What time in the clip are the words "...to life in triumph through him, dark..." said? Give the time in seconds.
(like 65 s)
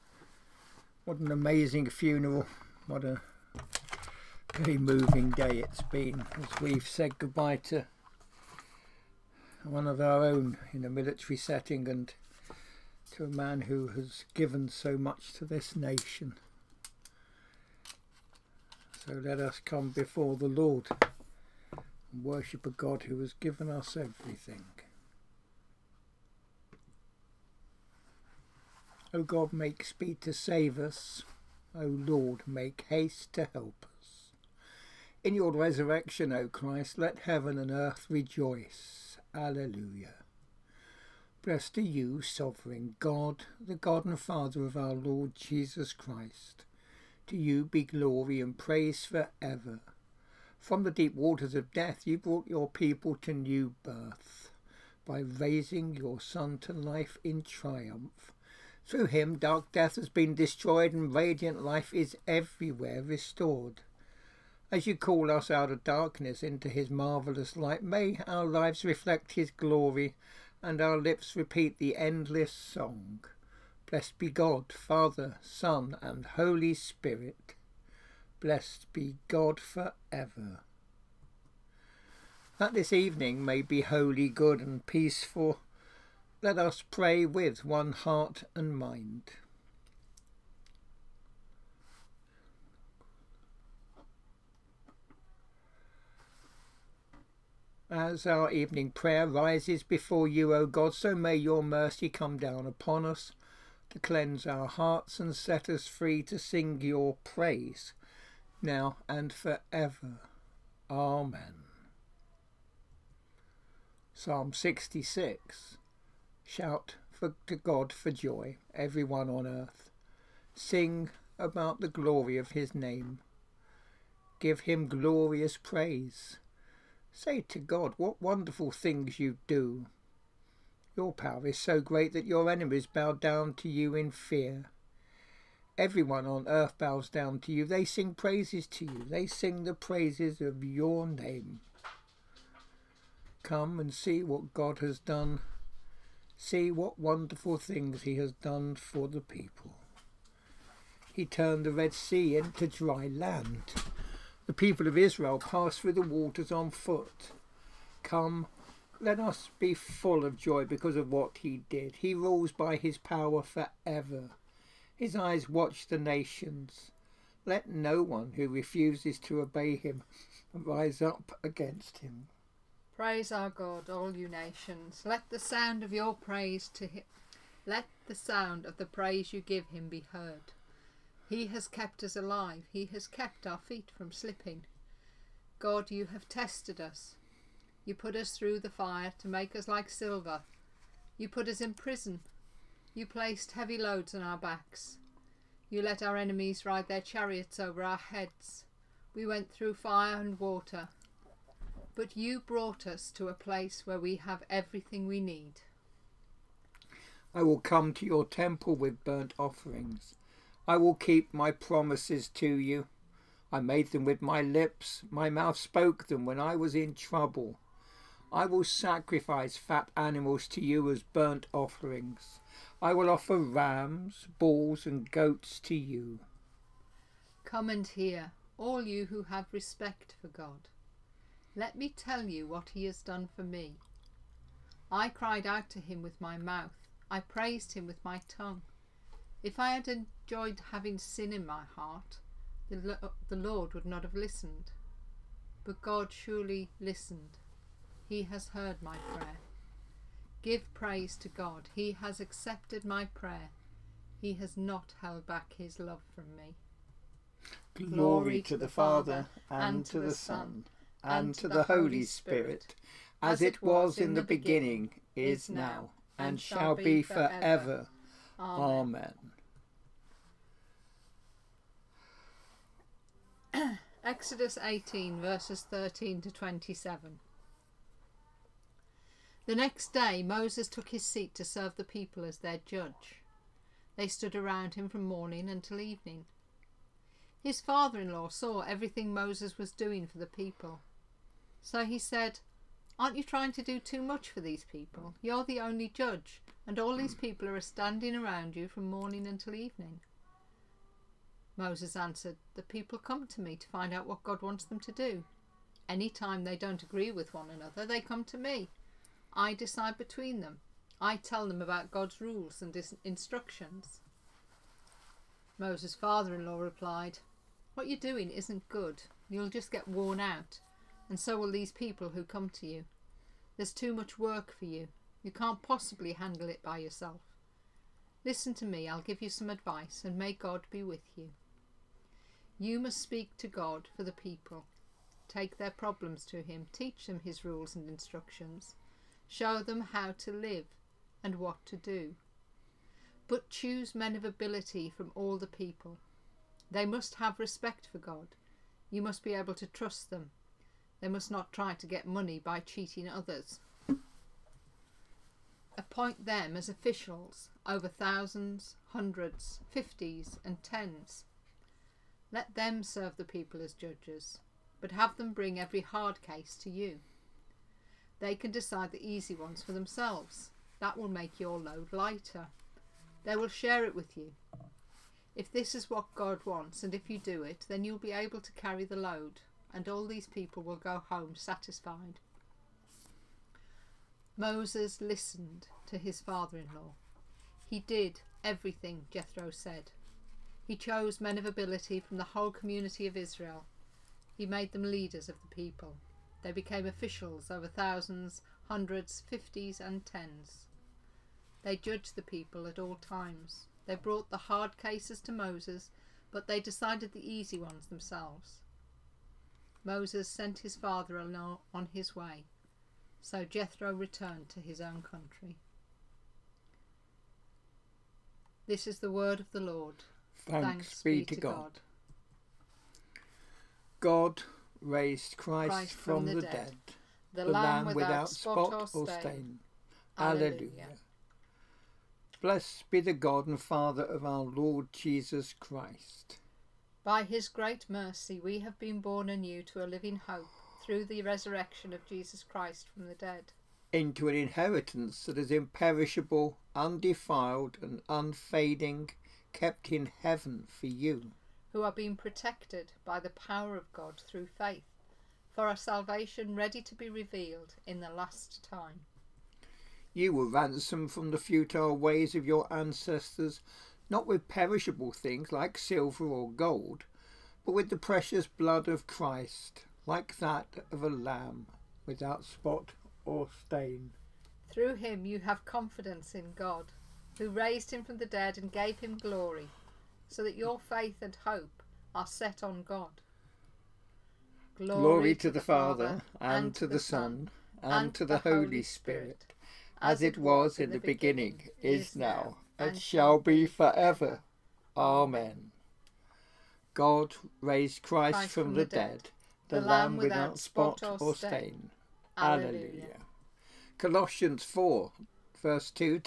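56 s.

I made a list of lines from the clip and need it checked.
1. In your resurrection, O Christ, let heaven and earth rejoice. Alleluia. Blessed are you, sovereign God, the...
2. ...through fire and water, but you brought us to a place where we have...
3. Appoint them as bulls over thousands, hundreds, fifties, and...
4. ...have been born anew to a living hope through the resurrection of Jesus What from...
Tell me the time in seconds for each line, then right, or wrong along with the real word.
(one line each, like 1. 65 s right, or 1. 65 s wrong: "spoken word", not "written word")
1. 35 s right
2. 199 s right
3. 355 s wrong: "officials", not "bulls"
4. 438 s wrong: "Christ", not "What".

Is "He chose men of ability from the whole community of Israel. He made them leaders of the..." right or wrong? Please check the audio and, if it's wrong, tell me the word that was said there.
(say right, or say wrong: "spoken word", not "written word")
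right.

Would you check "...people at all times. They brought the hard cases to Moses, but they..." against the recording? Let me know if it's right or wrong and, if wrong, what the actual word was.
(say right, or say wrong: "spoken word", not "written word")
right.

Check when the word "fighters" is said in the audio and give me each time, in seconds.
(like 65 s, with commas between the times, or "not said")
not said.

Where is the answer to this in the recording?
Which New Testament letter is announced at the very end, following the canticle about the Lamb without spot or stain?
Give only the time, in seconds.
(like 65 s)
503 s.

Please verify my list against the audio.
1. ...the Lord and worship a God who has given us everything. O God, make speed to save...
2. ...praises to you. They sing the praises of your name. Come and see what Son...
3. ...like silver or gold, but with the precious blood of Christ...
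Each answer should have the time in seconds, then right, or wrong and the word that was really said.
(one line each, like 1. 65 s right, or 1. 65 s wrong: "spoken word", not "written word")
1. 20 s right
2. 138 s wrong: "God", not "Son"
3. 465 s right.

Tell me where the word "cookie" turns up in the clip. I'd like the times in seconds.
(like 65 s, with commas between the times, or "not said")
not said.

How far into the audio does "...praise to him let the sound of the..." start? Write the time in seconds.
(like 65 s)
176 s.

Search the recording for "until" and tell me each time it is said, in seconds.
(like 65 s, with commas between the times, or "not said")
285 s, 299 s.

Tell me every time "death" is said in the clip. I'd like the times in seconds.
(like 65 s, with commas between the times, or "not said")
51 s, 59 s.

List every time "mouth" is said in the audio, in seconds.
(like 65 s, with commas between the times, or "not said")
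215 s, 236 s.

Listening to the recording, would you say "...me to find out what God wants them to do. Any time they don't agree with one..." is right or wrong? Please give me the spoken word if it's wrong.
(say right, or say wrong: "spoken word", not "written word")
right.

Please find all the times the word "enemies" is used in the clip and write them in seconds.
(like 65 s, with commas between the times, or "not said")
132 s, 196 s.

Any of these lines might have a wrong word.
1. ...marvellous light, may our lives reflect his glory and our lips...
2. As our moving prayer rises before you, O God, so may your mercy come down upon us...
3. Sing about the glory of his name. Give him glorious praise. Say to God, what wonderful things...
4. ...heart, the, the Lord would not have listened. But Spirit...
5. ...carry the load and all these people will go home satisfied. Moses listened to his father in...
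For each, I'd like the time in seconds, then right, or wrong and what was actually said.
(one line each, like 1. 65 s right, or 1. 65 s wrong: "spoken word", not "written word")
1. 66 s right
2. 97 s wrong: "evening", not "moving"
3. 120 s right
4. 241 s wrong: "God", not "Spirit"
5. 378 s right.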